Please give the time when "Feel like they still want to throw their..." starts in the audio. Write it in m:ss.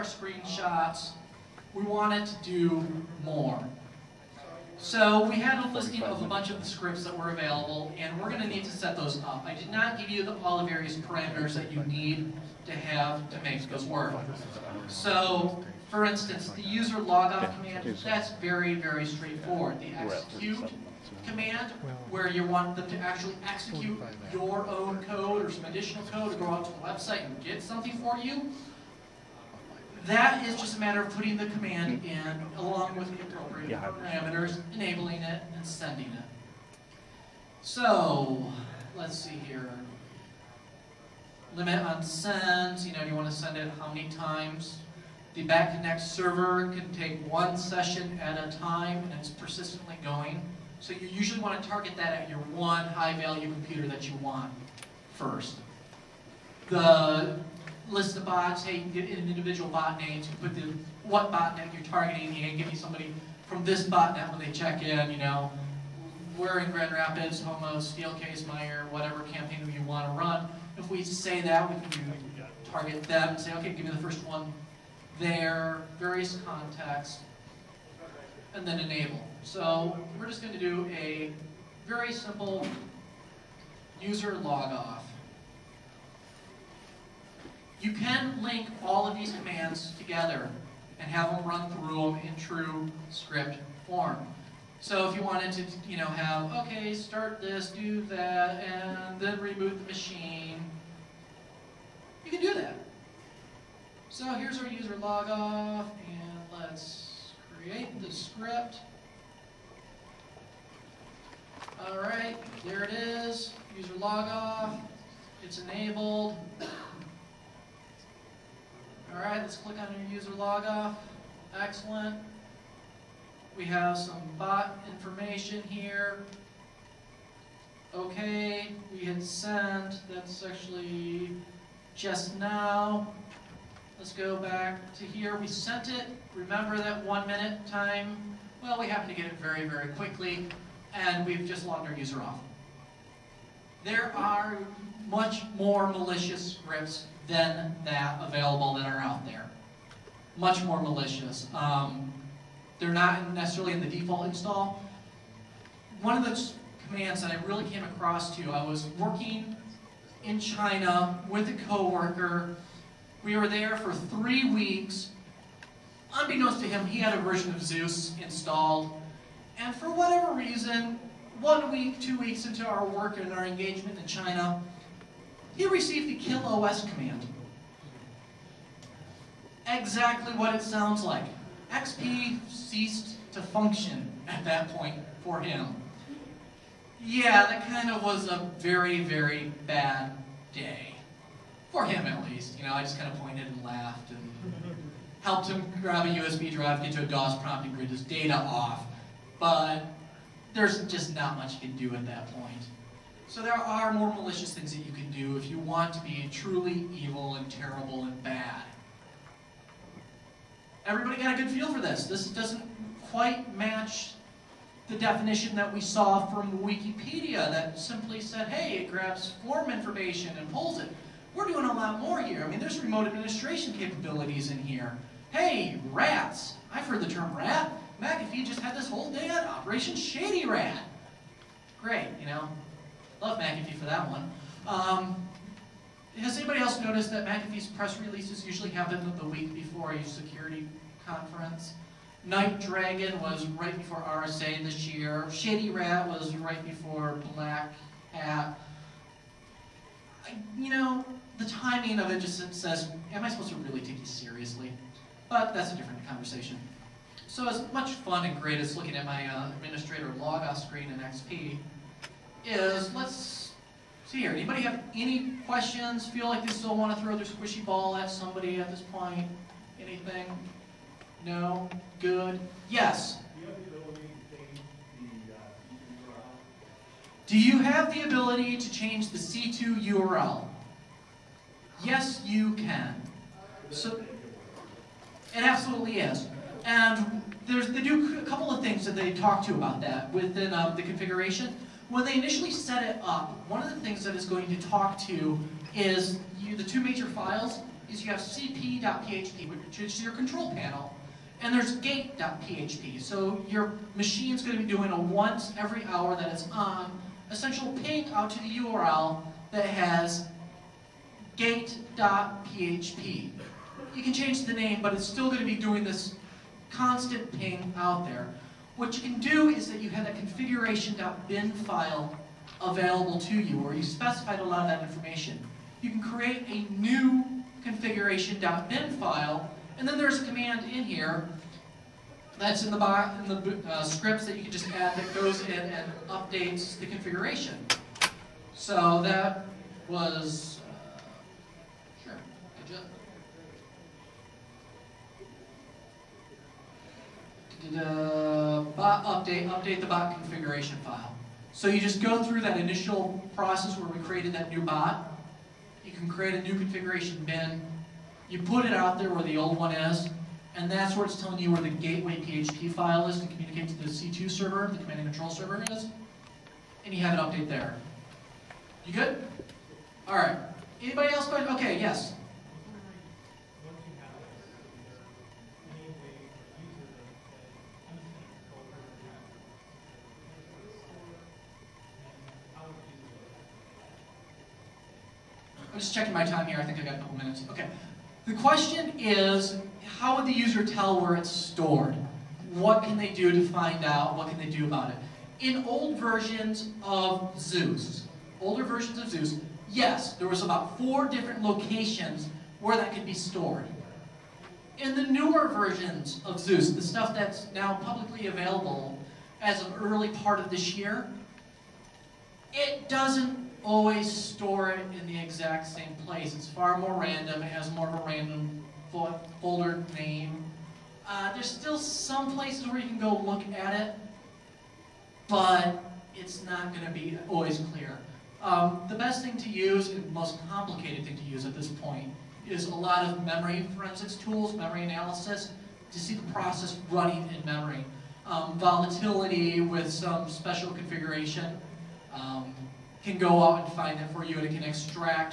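4:26.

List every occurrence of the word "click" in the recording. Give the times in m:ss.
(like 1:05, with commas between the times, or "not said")
1:59.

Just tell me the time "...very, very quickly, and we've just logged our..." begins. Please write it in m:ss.
2:19.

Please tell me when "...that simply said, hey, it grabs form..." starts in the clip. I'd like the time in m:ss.
3:37.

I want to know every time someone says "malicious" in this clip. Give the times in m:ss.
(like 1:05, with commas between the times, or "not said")
2:25, 2:30, 3:24.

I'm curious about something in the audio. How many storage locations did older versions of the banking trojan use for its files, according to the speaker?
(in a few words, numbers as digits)
4.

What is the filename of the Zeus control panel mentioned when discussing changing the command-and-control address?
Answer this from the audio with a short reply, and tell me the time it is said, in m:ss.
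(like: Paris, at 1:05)
cp.php, at 4:58.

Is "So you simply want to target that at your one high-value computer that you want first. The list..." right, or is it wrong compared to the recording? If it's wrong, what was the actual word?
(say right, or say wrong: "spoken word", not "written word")
wrong: "usually", not "simply".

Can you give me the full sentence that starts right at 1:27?
You can link all of these commands together and have them run through them in true script form.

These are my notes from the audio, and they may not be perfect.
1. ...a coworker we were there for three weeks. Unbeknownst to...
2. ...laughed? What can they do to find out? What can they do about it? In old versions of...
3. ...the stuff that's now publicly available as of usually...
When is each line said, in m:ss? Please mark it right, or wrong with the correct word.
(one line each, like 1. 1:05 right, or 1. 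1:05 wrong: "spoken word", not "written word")
1. 2:41 right
2. 6:31 wrong: "stored", not "laughed"
3. 6:46 wrong: "early", not "usually".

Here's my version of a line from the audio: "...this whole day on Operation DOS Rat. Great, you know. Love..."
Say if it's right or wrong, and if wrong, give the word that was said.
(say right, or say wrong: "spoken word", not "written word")
wrong: "Shady", not "DOS".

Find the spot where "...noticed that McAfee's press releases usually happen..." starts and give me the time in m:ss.
3:56.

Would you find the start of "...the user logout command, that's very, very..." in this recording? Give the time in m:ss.
0:16.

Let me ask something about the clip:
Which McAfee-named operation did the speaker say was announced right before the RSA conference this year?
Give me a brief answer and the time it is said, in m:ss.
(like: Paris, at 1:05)
Night Dragon, at 4:02.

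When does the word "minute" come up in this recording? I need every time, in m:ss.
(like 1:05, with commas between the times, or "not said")
2:17, 6:27.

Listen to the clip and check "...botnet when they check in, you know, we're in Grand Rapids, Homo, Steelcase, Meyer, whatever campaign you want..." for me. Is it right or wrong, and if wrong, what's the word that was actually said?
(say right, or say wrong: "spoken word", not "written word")
right.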